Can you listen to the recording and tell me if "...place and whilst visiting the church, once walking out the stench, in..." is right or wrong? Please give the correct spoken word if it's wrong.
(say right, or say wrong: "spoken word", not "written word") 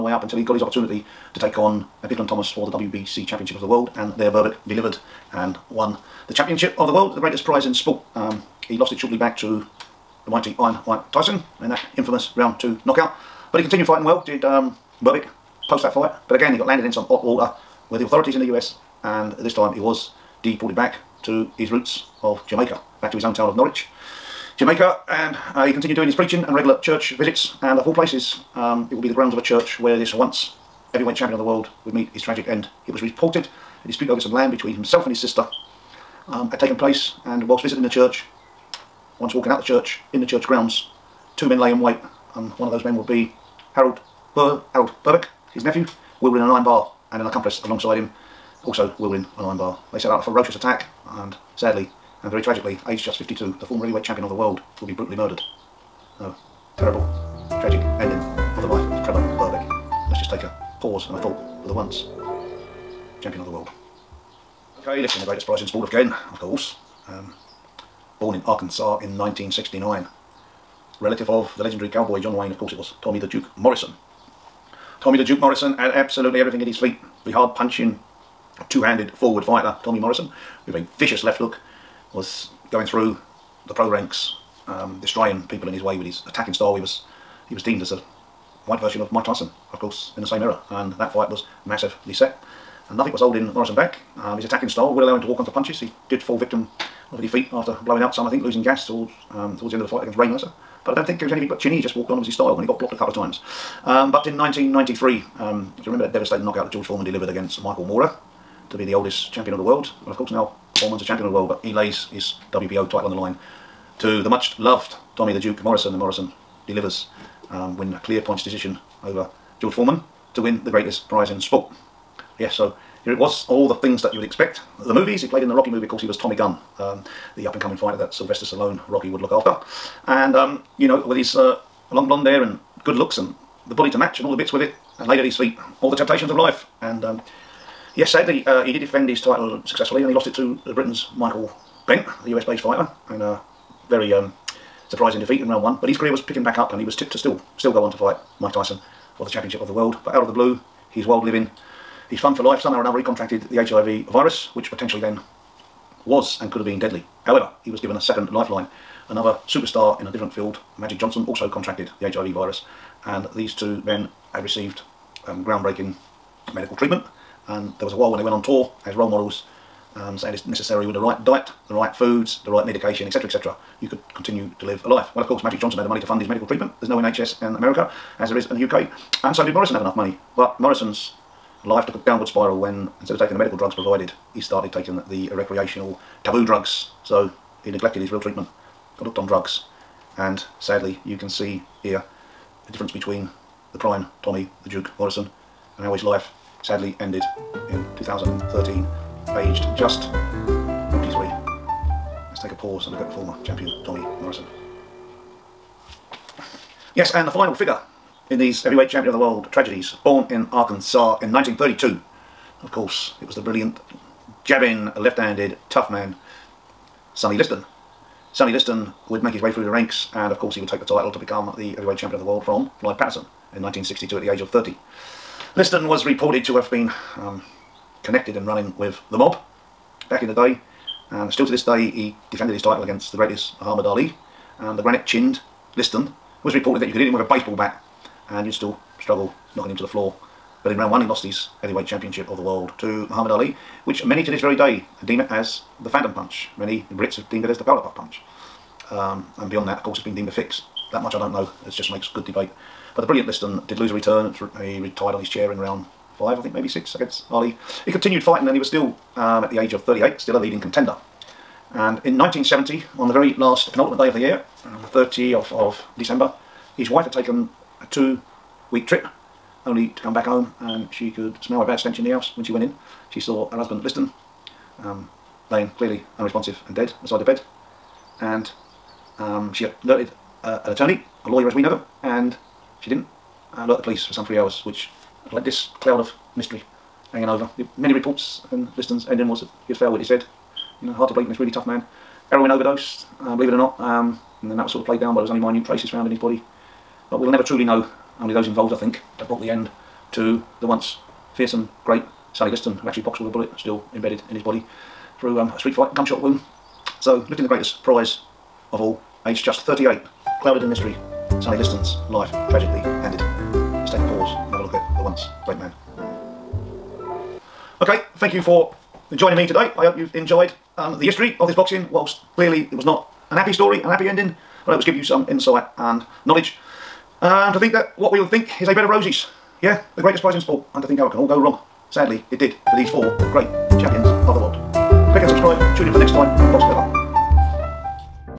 wrong: "church", not "stench".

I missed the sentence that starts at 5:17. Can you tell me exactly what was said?
Okay, thank you for joining me today.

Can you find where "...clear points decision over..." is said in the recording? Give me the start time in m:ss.
1:58.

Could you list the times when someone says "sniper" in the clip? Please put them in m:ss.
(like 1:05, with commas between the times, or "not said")
not said.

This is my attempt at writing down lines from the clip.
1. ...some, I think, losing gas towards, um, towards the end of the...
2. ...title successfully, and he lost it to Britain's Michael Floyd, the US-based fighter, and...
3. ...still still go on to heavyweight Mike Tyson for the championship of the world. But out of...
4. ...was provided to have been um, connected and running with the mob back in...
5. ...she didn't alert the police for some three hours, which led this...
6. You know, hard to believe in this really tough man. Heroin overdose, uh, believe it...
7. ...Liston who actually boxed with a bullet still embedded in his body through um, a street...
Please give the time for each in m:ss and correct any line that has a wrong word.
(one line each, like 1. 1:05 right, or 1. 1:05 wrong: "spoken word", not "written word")
1. 1:38 right
2. 2:19 wrong: "Bentt", not "Floyd"
3. 2:27 wrong: "fight", not "heavyweight"
4. 3:45 wrong: "reported", not "provided"
5. 4:42 right
6. 4:50 right
7. 5:02 right.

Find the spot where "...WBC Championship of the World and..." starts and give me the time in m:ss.
0:02.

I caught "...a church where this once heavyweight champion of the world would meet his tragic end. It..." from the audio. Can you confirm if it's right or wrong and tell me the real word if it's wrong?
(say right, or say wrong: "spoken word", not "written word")
right.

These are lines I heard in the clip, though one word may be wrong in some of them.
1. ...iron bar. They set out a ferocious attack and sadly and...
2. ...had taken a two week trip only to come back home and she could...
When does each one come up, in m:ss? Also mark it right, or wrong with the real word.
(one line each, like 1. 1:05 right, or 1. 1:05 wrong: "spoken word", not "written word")
1. 0:49 right
2. 4:27 right.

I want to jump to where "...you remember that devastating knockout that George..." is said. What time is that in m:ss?
1:45.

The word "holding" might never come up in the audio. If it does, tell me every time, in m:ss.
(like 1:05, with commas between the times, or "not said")
1:33.